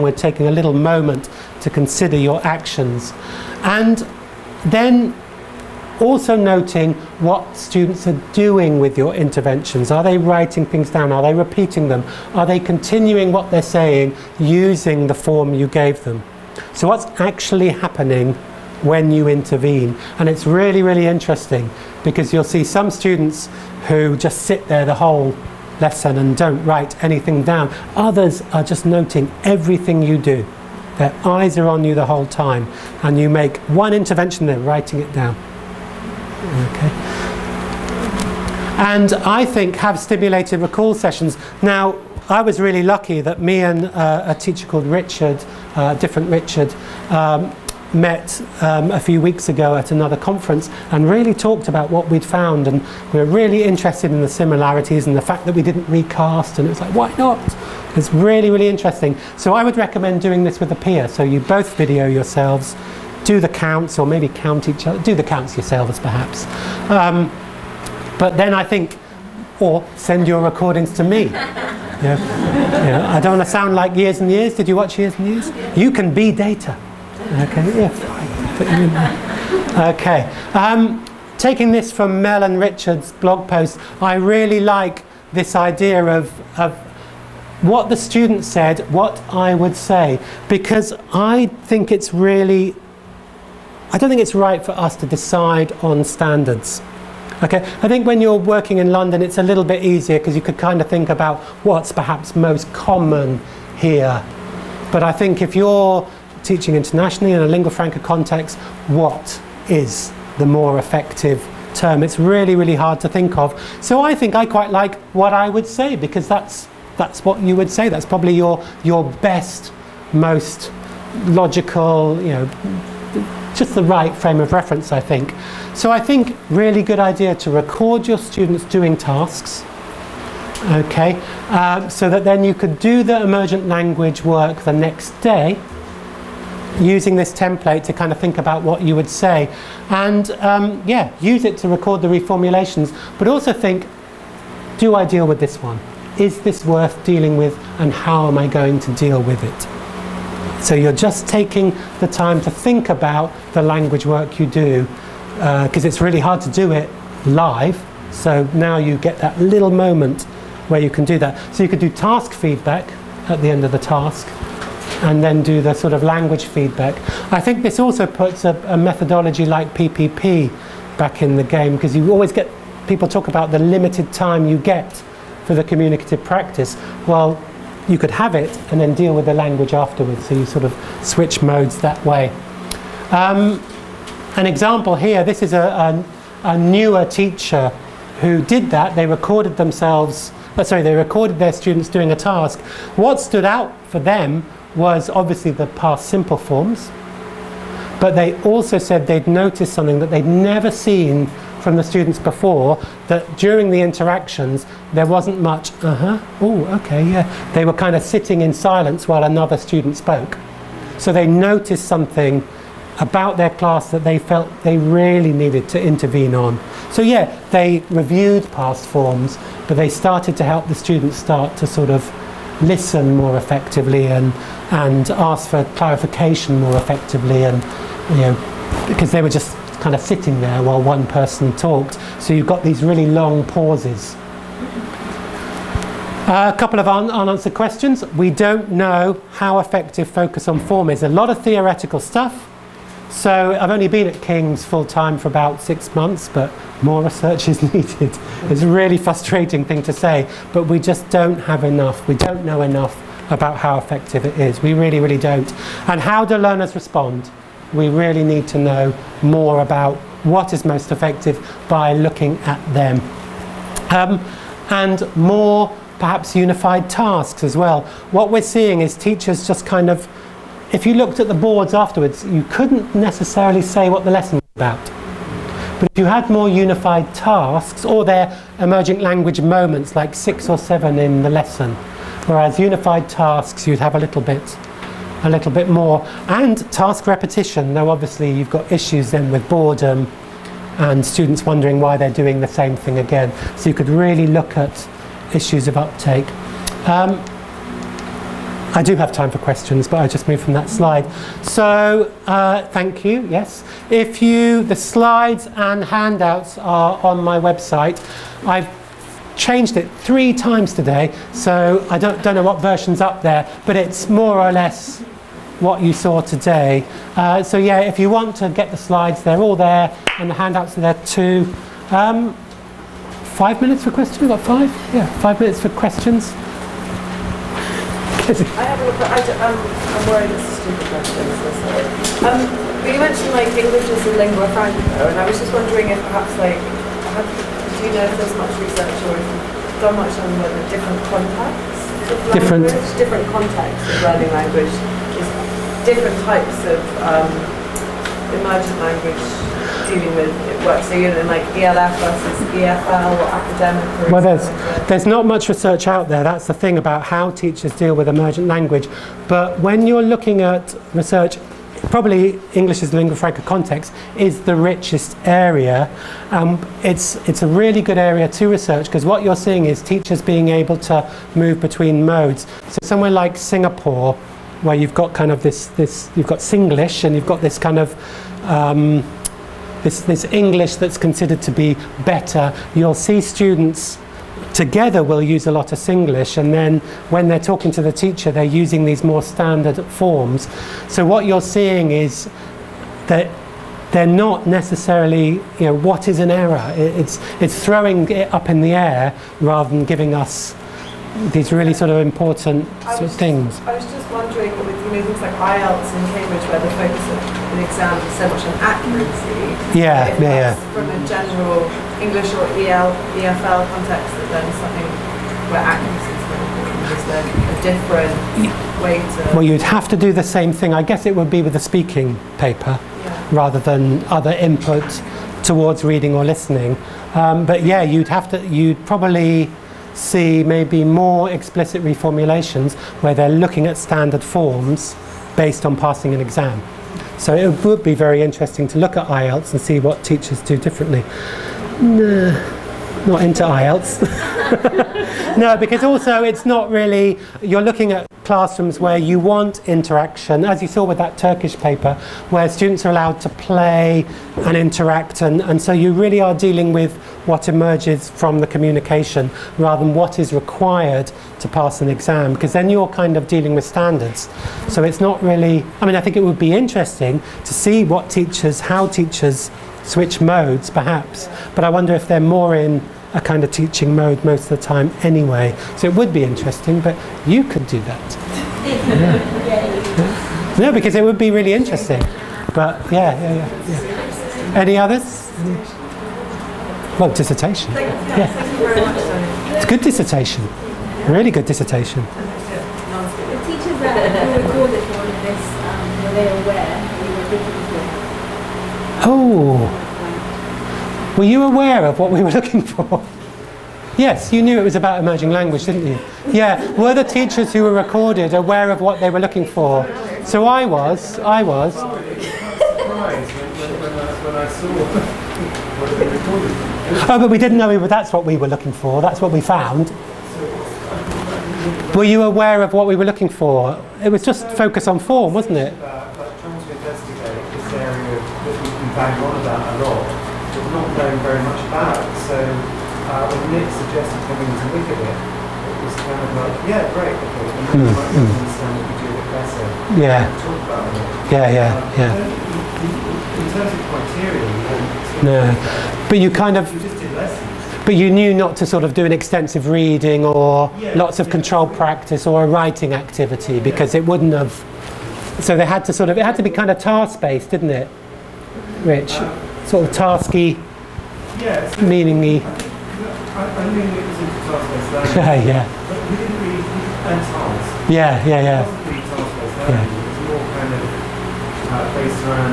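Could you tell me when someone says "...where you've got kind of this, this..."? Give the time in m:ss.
6:14.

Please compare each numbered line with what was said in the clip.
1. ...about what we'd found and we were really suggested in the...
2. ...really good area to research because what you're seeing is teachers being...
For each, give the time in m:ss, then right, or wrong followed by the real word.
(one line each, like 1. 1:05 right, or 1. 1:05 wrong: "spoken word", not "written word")
1. 0:51 wrong: "interested", not "suggested"
2. 6:07 right.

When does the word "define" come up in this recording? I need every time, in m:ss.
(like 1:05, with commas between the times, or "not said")
not said.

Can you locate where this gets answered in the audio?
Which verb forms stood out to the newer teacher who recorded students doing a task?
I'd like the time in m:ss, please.
3:15.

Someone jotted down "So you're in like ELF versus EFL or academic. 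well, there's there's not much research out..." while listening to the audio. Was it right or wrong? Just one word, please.
right.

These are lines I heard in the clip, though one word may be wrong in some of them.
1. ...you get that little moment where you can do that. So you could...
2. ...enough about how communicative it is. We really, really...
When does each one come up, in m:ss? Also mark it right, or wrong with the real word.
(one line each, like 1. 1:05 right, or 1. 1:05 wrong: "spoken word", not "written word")
1. 2:38 right
2. 4:12 wrong: "effective", not "communicative".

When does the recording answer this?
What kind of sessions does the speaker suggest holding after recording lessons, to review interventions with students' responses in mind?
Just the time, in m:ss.
0:39.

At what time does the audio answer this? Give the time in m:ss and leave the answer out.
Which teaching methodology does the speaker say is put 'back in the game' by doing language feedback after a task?
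2:49.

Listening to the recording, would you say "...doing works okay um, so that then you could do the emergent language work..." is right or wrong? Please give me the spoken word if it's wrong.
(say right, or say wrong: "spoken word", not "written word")
wrong: "tasks", not "works".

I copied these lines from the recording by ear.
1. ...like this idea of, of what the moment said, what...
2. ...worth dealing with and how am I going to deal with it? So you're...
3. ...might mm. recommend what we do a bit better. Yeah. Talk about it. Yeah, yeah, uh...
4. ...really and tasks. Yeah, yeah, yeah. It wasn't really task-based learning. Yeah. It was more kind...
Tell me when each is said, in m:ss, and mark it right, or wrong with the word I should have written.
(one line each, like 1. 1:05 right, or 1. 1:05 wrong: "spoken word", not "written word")
1. 1:24 wrong: "student", not "moment"
2. 2:26 right
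3. 8:57 wrong: "understand", not "recommend"
4. 9:26 right.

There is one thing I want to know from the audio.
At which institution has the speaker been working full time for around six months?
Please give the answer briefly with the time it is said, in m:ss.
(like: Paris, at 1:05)
King's, at 4:04.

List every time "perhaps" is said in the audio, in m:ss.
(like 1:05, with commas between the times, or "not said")
1:05, 1:41, 4:25, 5:35, 7:50.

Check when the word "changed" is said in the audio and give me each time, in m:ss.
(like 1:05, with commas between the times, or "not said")
5:09.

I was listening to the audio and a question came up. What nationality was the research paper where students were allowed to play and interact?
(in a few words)
Turkish.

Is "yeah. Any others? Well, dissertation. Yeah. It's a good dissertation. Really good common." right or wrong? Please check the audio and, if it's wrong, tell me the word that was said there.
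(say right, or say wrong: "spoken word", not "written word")
wrong: "dissertation", not "common".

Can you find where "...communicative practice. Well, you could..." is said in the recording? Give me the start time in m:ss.
2:55.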